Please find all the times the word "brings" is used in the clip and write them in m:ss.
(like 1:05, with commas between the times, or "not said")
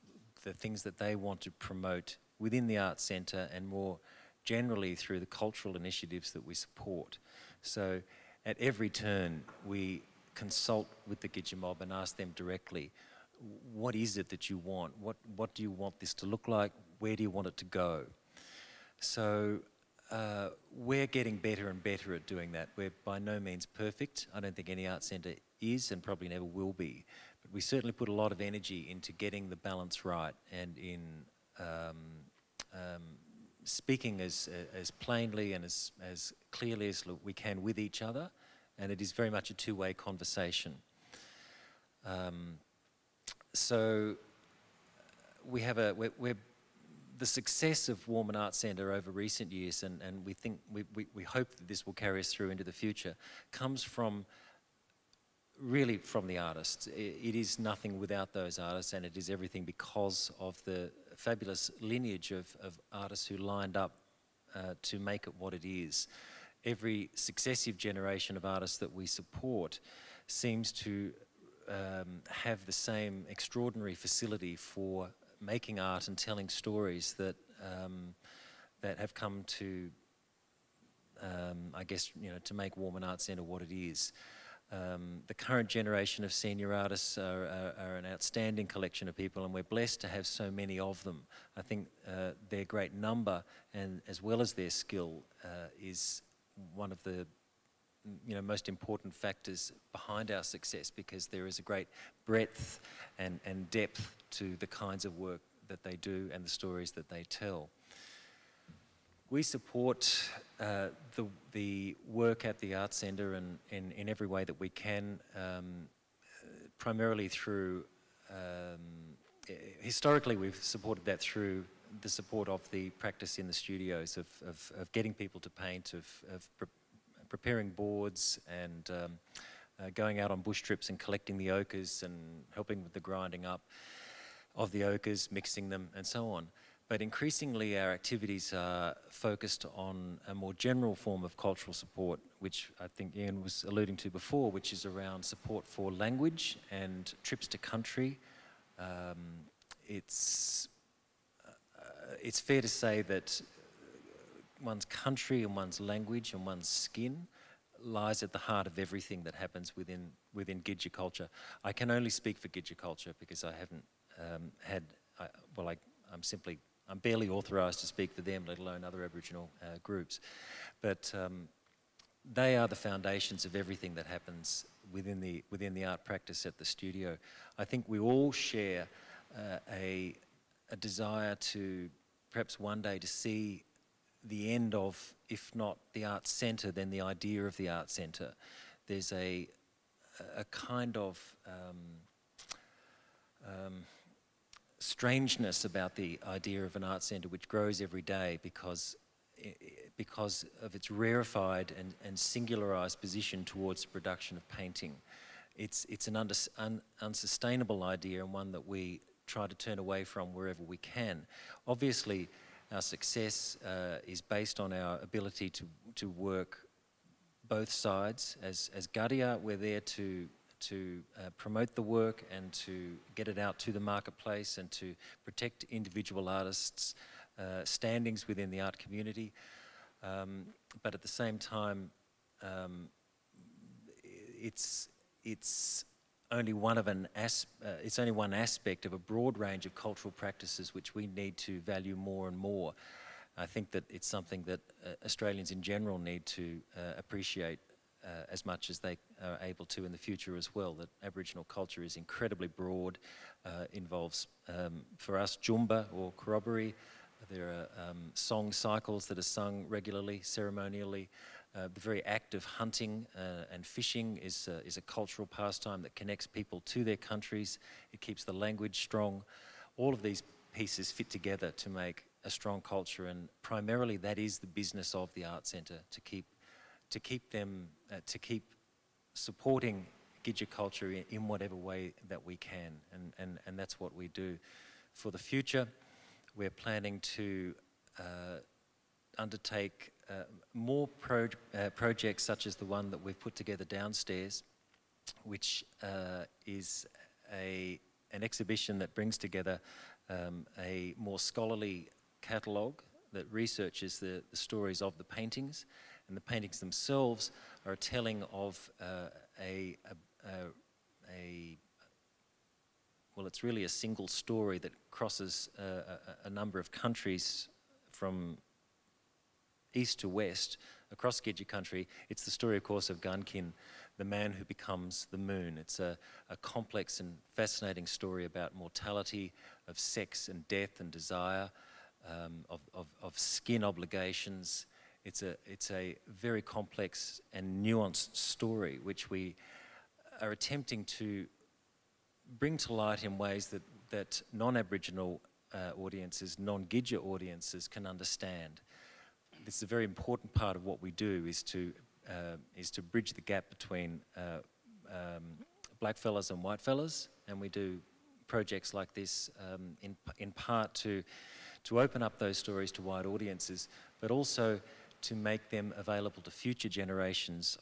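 4:58, 5:42.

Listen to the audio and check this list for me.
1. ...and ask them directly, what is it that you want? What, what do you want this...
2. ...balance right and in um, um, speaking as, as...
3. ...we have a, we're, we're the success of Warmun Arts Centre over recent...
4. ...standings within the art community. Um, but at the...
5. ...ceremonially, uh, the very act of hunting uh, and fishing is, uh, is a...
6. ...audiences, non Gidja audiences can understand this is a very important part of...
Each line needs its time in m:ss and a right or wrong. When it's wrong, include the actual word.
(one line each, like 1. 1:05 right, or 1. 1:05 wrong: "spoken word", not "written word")
1. 0:11 right
2. 0:29 right
3. 0:45 right
4. 3:47 right
5. 4:20 right
6. 5:45 right.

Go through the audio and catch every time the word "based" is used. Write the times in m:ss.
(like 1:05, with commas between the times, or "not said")
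3:34.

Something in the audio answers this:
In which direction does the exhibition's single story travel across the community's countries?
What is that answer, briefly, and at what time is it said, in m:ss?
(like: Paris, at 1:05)
East to west, at 5:19.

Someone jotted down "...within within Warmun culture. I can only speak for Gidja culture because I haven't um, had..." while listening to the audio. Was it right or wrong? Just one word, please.
wrong.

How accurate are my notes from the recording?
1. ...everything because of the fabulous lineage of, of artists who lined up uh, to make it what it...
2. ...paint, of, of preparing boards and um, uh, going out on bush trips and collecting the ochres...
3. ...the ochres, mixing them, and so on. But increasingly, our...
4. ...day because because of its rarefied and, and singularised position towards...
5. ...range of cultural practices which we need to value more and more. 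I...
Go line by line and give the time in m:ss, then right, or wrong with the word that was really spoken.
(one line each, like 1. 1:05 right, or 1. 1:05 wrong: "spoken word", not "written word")
1. 0:59 right
2. 2:05 right
3. 2:14 right
4. 3:18 right
5. 3:59 right.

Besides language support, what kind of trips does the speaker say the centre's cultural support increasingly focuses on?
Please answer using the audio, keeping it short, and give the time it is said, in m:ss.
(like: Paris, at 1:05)
Trips to country, at 2:27.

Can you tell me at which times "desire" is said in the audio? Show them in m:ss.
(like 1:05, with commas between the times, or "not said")
3:00, 5:30.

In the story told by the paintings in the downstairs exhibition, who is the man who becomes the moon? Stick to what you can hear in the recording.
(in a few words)
Garnkiny.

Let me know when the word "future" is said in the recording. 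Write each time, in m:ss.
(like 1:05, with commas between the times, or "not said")
0:52, 4:09, 4:45, 6:06.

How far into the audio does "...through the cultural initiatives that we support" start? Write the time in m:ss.
0:04.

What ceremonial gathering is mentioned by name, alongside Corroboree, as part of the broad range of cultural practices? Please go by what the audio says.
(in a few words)
Joonba.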